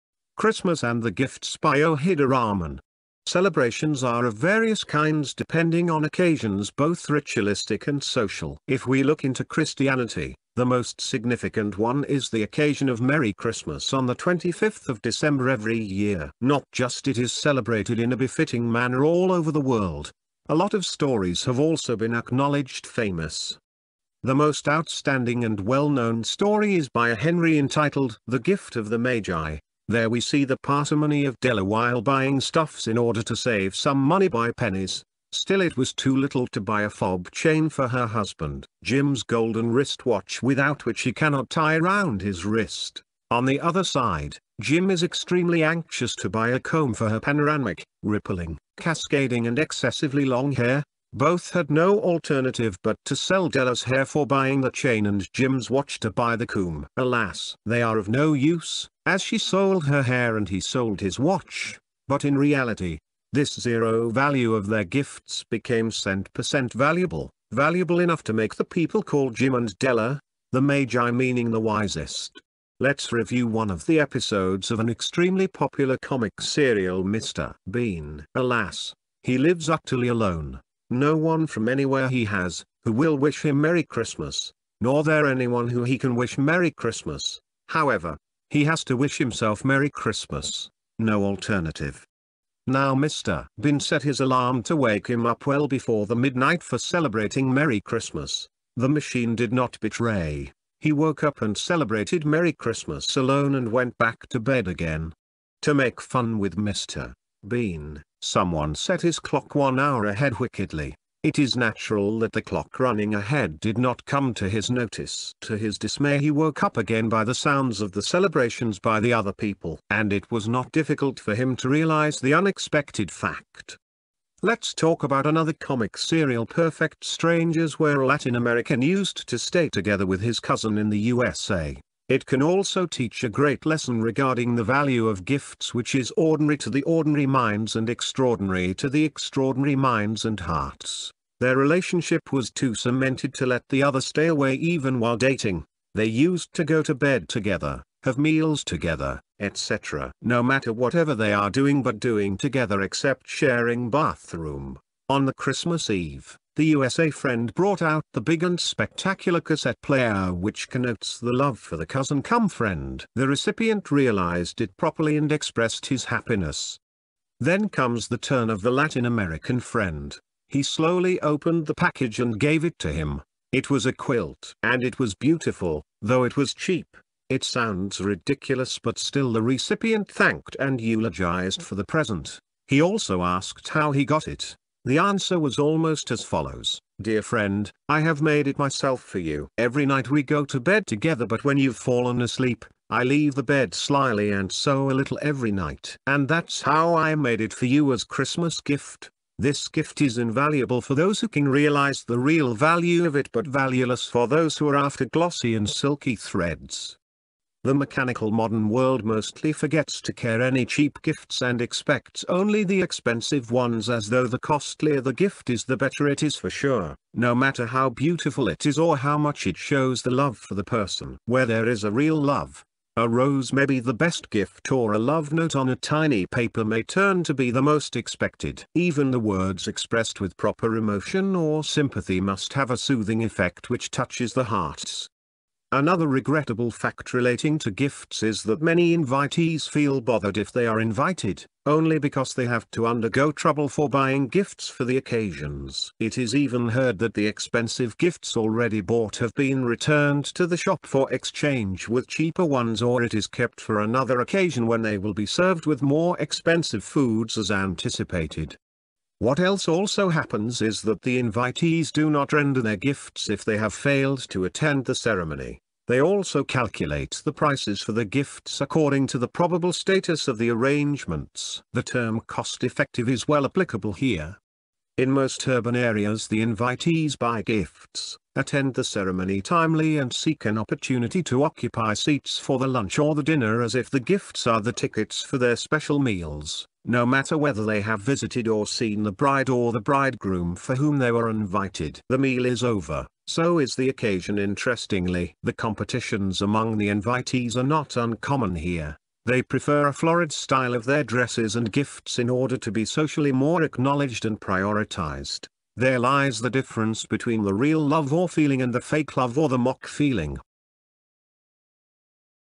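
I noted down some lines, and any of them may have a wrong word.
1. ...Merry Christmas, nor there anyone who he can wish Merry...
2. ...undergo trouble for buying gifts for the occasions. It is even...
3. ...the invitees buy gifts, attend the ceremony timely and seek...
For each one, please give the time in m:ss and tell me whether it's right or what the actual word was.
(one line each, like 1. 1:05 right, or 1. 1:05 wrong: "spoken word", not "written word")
1. 1:23 right
2. 4:02 right
3. 4:36 right.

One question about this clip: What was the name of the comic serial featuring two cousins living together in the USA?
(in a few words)
Perfect Strangers.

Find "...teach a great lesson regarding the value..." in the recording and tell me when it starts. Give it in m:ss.
2:12.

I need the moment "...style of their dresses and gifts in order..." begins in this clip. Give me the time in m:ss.
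5:00.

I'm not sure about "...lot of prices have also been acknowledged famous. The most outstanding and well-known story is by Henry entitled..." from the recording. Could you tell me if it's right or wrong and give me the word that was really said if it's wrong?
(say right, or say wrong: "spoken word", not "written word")
wrong: "stories", not "prices".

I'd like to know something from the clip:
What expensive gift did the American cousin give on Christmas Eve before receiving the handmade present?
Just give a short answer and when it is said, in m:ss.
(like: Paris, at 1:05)
cassette player, at 2:39.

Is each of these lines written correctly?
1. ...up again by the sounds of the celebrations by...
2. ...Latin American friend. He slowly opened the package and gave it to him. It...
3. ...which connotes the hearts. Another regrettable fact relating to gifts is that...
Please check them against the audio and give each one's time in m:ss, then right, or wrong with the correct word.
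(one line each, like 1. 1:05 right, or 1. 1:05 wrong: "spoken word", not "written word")
1. 1:56 right
2. 2:48 right
3. 3:53 wrong: "touches", not "connotes".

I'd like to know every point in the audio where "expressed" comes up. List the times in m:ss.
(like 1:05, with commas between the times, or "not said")
2:45, 3:49.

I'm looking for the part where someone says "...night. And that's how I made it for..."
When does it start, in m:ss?
3:15.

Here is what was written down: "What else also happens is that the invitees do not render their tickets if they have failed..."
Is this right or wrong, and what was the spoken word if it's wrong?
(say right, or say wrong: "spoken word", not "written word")
wrong: "gifts", not "tickets".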